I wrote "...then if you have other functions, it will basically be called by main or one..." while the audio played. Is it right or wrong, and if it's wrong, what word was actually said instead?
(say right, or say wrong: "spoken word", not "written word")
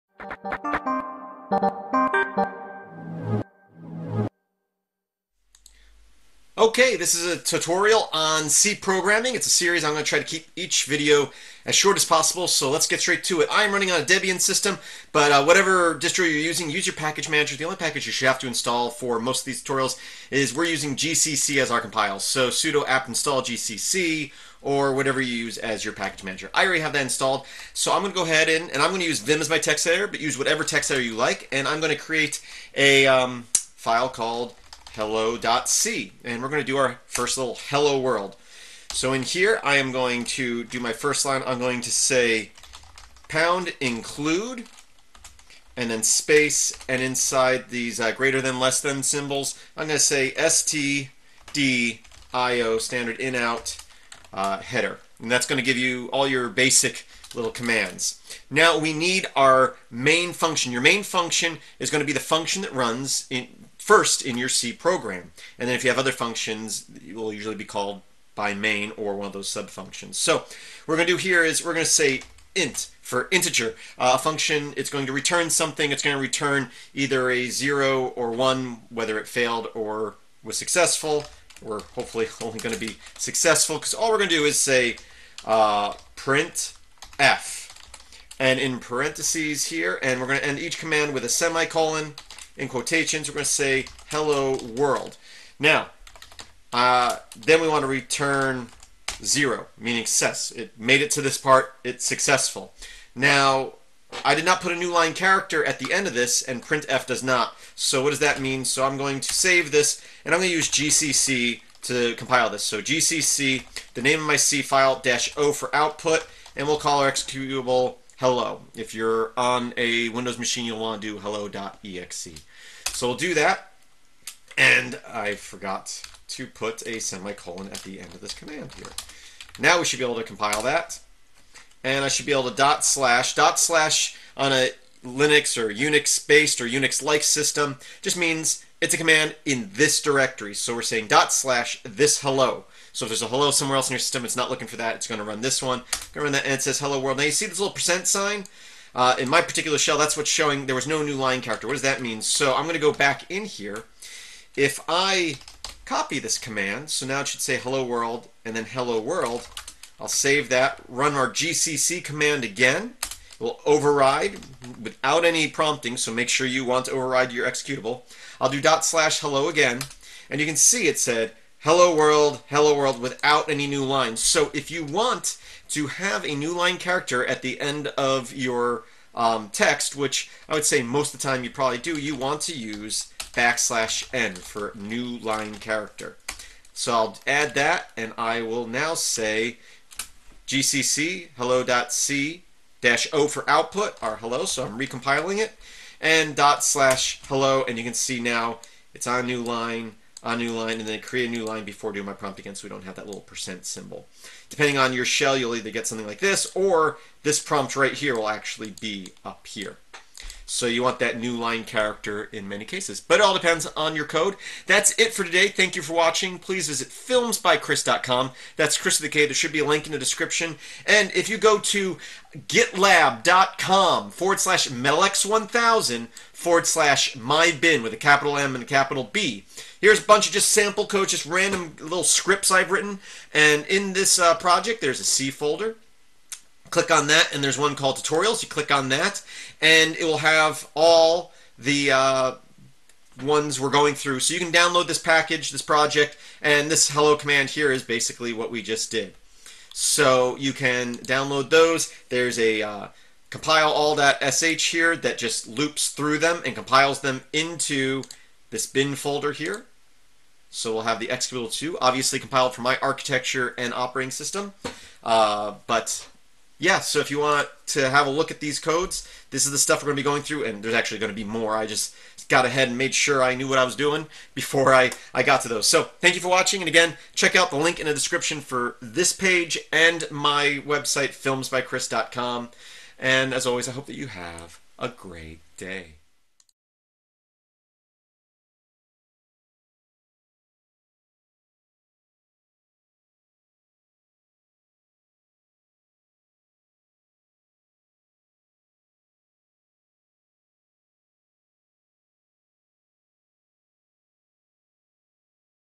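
wrong: "usually", not "basically".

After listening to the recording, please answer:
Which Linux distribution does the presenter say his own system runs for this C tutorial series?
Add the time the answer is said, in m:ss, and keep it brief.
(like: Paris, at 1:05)
Debian, at 0:14.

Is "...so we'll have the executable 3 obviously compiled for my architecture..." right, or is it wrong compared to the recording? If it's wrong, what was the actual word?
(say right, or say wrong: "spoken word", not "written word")
wrong: "2", not "3".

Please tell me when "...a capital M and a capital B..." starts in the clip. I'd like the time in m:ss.
3:47.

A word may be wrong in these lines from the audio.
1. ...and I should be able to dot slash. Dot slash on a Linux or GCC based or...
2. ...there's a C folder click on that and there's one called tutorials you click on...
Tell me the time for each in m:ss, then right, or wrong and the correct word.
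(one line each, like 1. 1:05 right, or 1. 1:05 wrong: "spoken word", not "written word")
1. 2:11 wrong: "Unix", not "GCC"
2. 3:54 right.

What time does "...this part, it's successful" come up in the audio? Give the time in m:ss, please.
1:41.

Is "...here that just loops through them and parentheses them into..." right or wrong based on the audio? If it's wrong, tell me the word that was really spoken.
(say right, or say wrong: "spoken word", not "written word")
wrong: "compiles", not "parentheses".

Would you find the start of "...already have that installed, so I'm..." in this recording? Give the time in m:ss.
0:26.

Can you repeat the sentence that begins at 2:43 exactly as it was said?
It will override without any prompting, so make sure you want to override your executable.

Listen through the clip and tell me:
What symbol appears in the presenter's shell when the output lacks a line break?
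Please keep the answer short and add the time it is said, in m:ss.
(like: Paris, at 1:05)
percent sign, at 2:27.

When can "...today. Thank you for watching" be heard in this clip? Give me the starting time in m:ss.
3:35.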